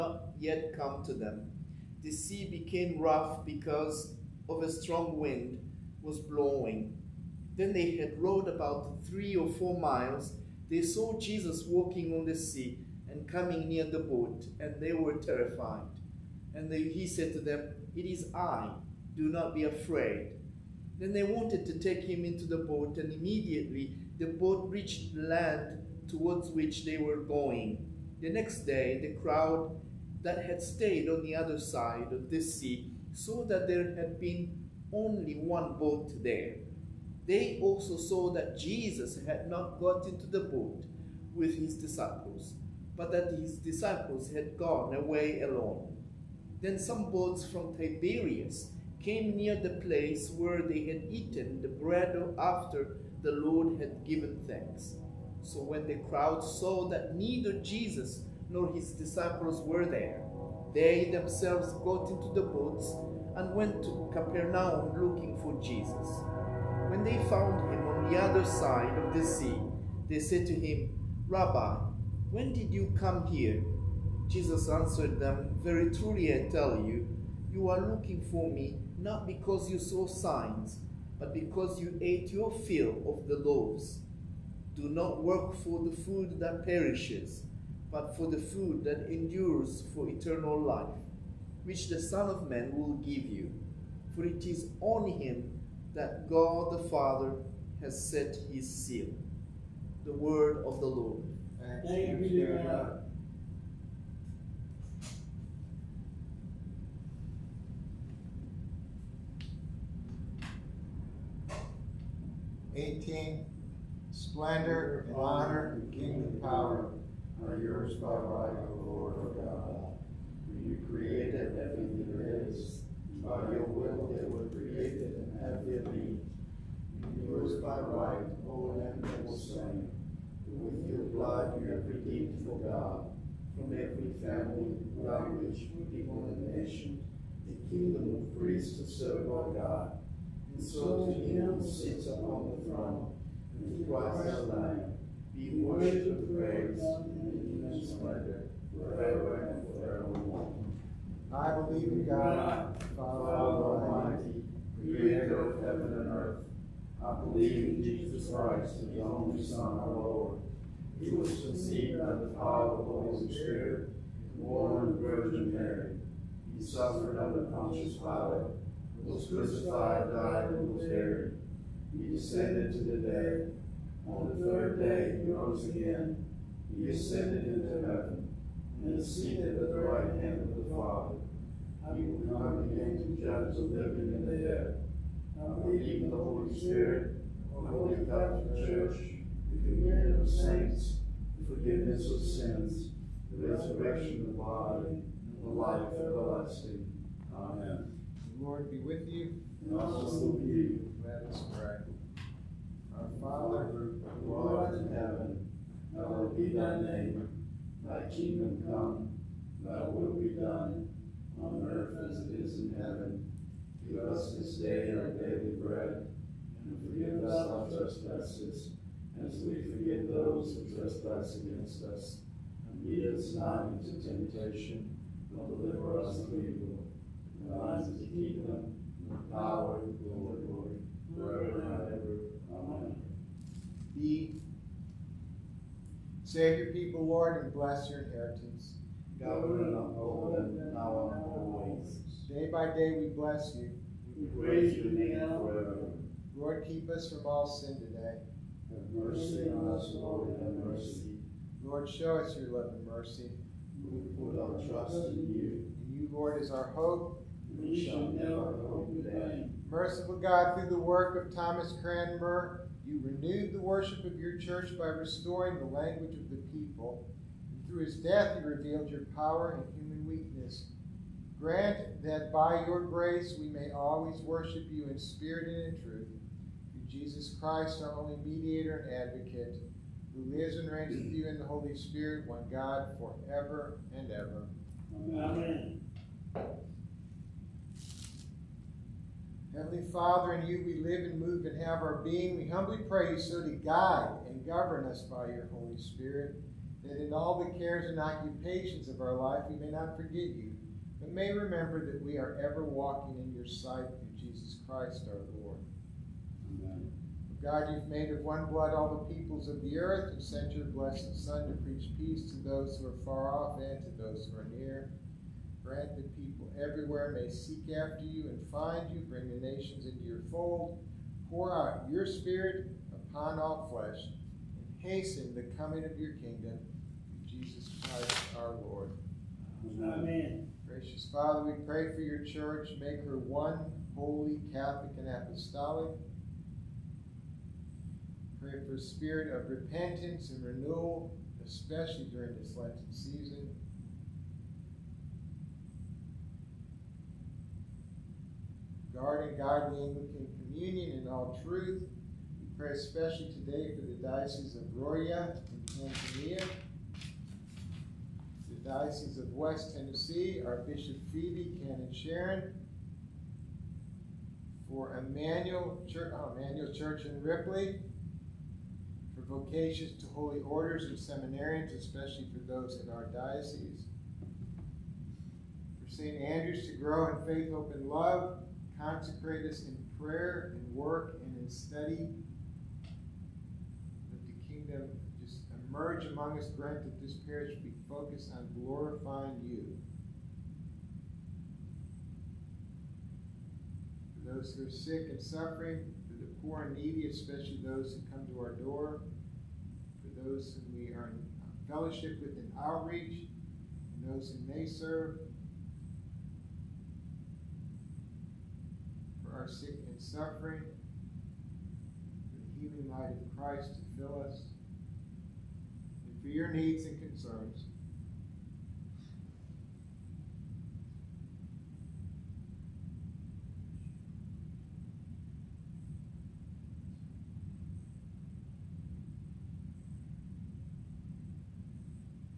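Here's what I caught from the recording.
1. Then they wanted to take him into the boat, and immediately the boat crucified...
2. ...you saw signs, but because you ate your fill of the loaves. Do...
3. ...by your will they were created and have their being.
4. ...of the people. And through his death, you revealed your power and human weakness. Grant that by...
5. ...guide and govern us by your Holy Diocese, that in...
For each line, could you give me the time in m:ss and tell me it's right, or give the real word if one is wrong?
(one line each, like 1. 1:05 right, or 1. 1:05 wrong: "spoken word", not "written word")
1. 0:20 wrong: "reached", not "crucified"
2. 1:19 right
3. 2:03 right
4. 4:26 right
5. 4:53 wrong: "Spirit", not "Diocese".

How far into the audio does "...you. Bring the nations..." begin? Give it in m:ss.
5:18.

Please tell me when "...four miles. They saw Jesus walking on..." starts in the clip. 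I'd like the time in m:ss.
0:09.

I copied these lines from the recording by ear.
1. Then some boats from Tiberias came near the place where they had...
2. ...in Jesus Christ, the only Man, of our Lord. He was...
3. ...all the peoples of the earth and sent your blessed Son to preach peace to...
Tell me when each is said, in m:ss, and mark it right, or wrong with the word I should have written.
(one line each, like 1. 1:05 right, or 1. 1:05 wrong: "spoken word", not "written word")
1. 0:46 right
2. 2:37 wrong: "Son", not "Man"
3. 5:08 right.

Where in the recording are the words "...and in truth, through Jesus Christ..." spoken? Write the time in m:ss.
4:35.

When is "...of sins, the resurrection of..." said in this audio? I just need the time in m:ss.
3:12.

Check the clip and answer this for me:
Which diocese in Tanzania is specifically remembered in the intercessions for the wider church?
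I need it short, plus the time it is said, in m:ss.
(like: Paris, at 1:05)
Diocese of Ruaha, at 5:54.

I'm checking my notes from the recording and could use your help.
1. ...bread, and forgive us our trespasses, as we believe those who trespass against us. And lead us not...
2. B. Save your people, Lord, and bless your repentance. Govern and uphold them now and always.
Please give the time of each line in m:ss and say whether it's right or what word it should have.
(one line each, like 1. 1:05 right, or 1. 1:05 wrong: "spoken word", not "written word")
1. 3:35 wrong: "forgive", not "believe"
2. 3:53 wrong: "inheritance", not "repentance".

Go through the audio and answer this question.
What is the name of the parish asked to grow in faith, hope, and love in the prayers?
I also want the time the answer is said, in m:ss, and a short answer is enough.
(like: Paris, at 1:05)
St. Andrew's, at 6:15.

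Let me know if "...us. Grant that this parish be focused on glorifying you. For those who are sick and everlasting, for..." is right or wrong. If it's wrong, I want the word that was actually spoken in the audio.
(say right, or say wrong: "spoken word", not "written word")
wrong: "suffering", not "everlasting".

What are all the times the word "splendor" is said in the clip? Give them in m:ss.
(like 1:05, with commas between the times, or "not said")
1:54, 2:27.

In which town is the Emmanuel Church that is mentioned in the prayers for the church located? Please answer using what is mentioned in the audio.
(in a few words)
Ripley.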